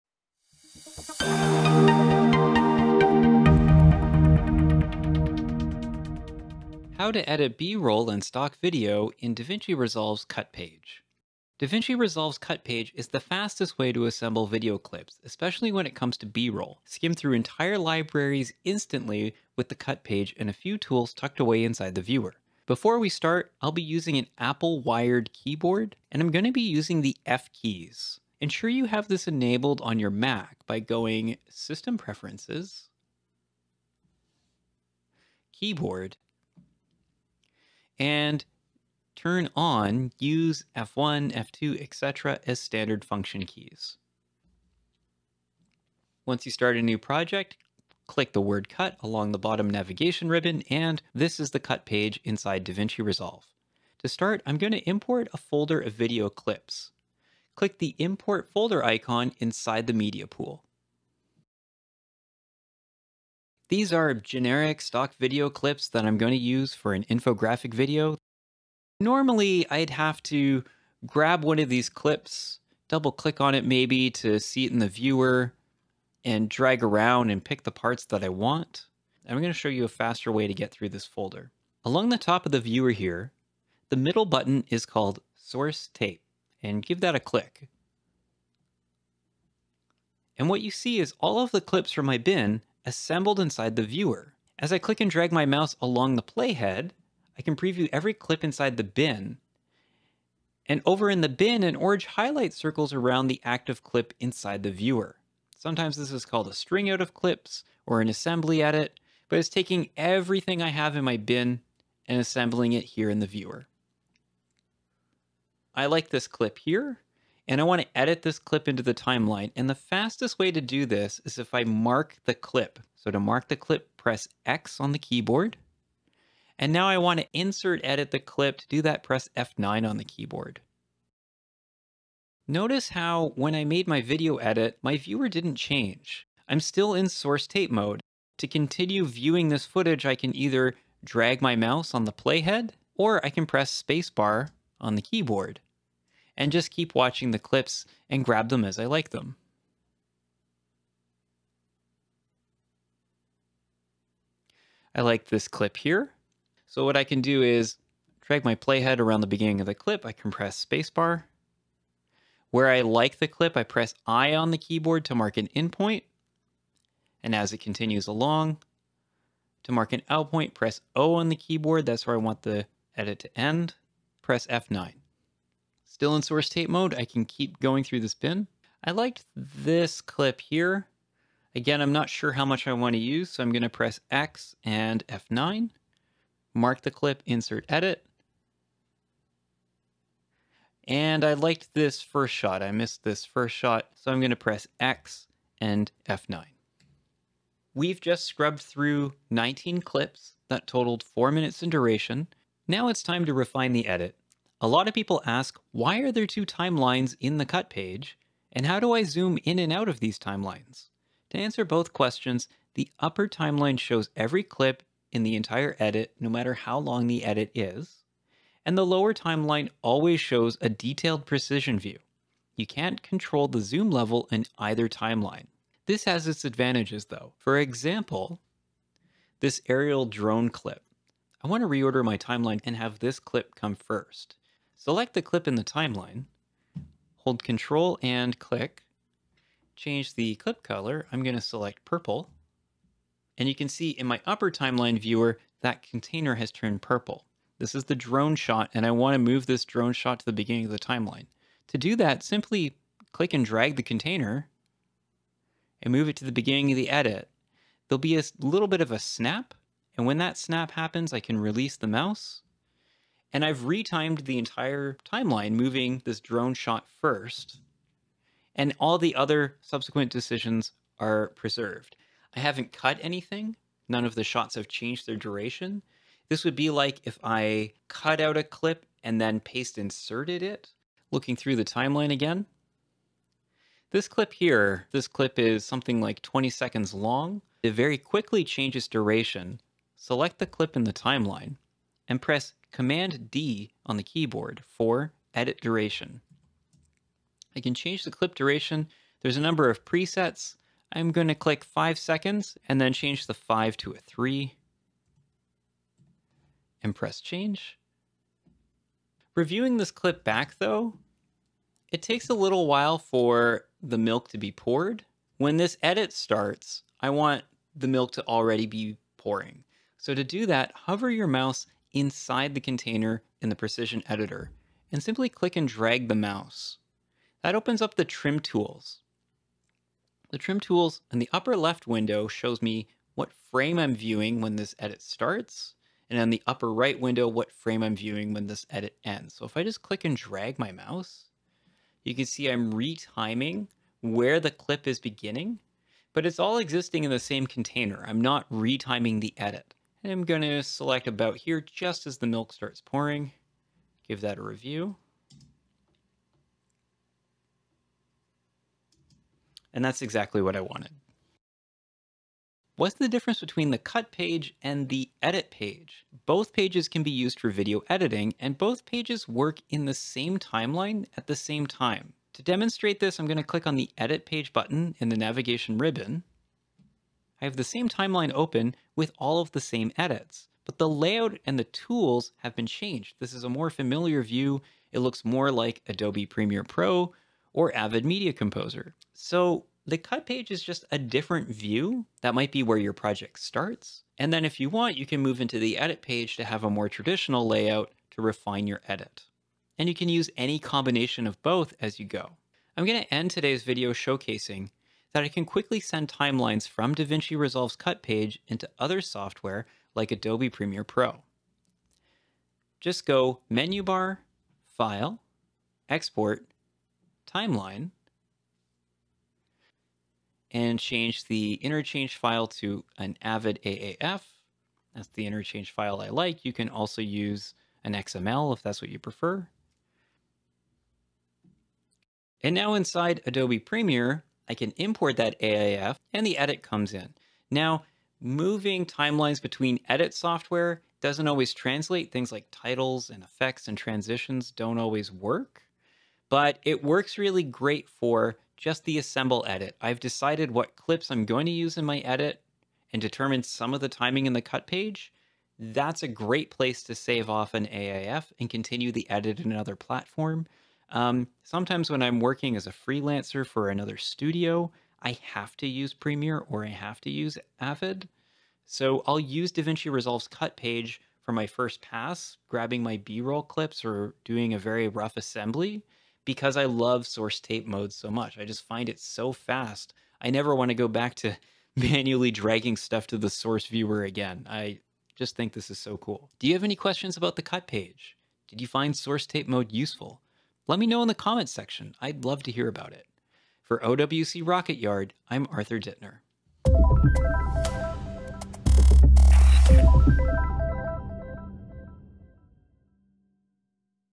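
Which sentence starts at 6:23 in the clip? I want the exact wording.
This is a more familiar view.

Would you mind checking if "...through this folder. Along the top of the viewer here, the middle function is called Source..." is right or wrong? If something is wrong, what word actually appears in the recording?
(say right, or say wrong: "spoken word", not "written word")
wrong: "button", not "function".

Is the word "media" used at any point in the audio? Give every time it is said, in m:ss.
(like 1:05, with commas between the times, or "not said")
0:59, 6:28.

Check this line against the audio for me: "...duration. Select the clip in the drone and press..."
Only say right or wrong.
wrong.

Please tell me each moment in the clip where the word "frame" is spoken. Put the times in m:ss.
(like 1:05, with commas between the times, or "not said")
5:33, 5:37.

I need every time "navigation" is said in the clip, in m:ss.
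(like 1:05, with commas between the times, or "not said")
0:49, 6:15.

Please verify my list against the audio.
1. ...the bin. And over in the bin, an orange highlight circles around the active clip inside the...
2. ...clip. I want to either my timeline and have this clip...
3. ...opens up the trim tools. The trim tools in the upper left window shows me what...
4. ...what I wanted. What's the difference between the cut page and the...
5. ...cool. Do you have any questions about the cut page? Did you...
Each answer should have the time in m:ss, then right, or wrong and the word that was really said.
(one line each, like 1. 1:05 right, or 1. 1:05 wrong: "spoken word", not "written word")
1. 1:38 right
2. 3:50 wrong: "reorder", not "either"
3. 5:27 right
4. 6:00 right
5. 8:05 right.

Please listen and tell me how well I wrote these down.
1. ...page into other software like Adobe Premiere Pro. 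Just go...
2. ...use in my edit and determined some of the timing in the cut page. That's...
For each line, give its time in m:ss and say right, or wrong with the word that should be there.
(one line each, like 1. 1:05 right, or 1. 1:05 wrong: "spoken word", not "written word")
1. 6:48 right
2. 7:31 right.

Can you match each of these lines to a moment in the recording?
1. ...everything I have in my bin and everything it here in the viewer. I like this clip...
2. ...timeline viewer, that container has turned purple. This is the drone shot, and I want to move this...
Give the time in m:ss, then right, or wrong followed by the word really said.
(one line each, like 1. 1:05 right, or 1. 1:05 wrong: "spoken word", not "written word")
1. 1:49 wrong: "assembling", not "everything"
2. 4:04 right.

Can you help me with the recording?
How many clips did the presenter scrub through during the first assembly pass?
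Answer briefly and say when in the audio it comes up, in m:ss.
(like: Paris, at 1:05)
19, at 3:19.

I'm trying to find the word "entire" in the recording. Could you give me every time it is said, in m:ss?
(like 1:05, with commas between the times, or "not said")
0:17, 3:35, 4:24.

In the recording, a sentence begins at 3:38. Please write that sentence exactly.
And the lower timeline always shows a detailed precision view.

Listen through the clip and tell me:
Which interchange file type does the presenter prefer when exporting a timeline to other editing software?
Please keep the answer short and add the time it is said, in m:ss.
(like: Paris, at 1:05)
Avid AAF, at 7:03.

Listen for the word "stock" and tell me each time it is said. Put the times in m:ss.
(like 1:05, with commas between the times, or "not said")
0:08, 1:04.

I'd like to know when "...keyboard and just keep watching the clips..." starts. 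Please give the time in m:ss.
2:25.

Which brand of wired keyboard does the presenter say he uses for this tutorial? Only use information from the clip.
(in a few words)
Apple.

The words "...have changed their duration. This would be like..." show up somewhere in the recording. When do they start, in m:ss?
4:34.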